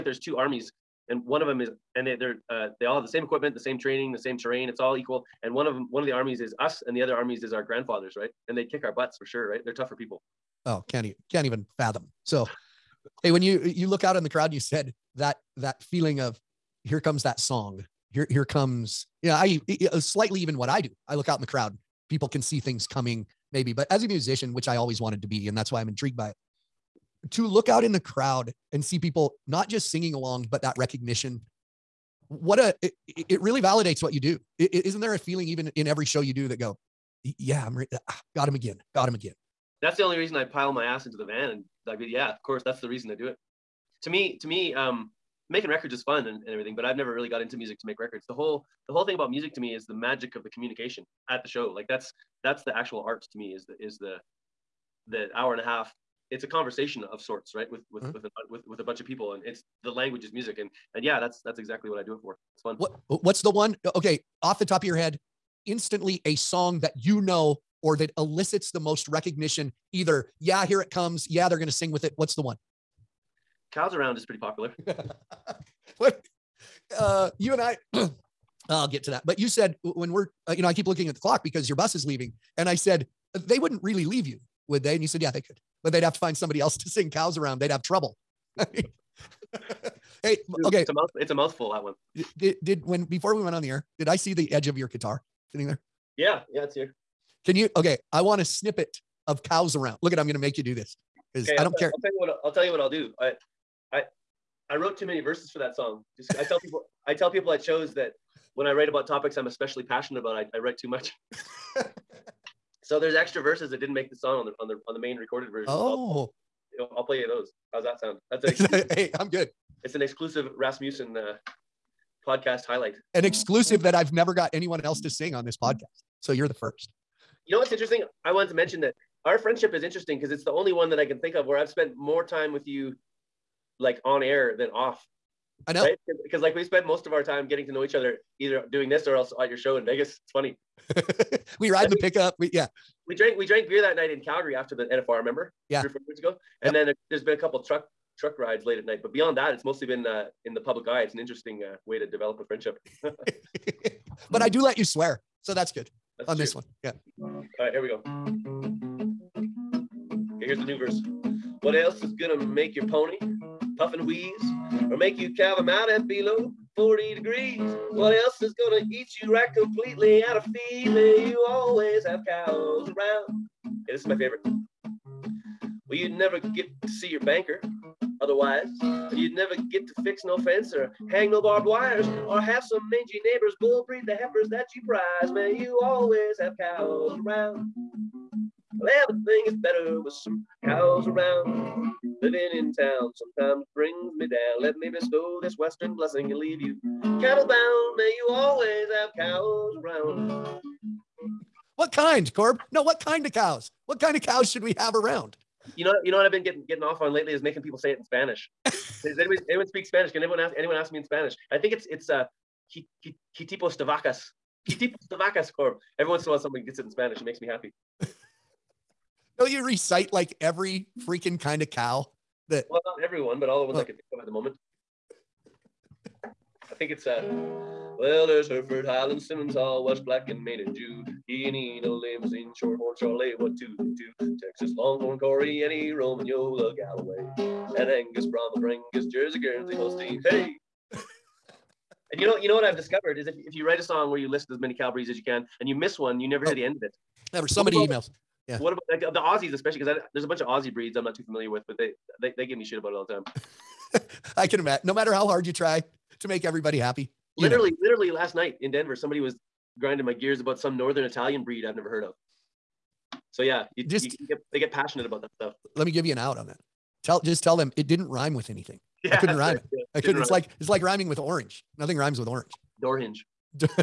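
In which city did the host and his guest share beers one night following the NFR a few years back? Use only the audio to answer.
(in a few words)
Calgary.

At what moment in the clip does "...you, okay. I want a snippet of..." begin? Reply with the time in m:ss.
1:37.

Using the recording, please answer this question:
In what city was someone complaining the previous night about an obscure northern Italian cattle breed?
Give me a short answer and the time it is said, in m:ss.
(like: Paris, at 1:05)
Denver, at 4:18.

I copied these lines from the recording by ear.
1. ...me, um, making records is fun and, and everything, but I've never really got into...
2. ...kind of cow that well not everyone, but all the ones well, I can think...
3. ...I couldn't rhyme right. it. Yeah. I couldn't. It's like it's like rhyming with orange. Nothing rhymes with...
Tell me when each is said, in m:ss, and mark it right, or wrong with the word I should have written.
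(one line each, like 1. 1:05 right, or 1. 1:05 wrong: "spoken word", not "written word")
1. 0:44 right
2. 3:41 right
3. 4:29 right.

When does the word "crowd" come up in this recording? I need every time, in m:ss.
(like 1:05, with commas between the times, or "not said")
0:14, 0:21, 0:28.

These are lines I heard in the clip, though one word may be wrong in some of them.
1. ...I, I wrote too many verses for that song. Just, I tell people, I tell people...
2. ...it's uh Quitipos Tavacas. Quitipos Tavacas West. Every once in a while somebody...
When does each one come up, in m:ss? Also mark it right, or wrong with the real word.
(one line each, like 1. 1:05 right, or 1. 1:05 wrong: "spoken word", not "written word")
1. 1:43 right
2. 3:31 wrong: "Corb", not "West".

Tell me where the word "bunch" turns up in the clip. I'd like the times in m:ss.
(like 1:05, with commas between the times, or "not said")
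0:58, 4:10.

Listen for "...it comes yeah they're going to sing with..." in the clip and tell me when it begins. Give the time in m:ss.
1:10.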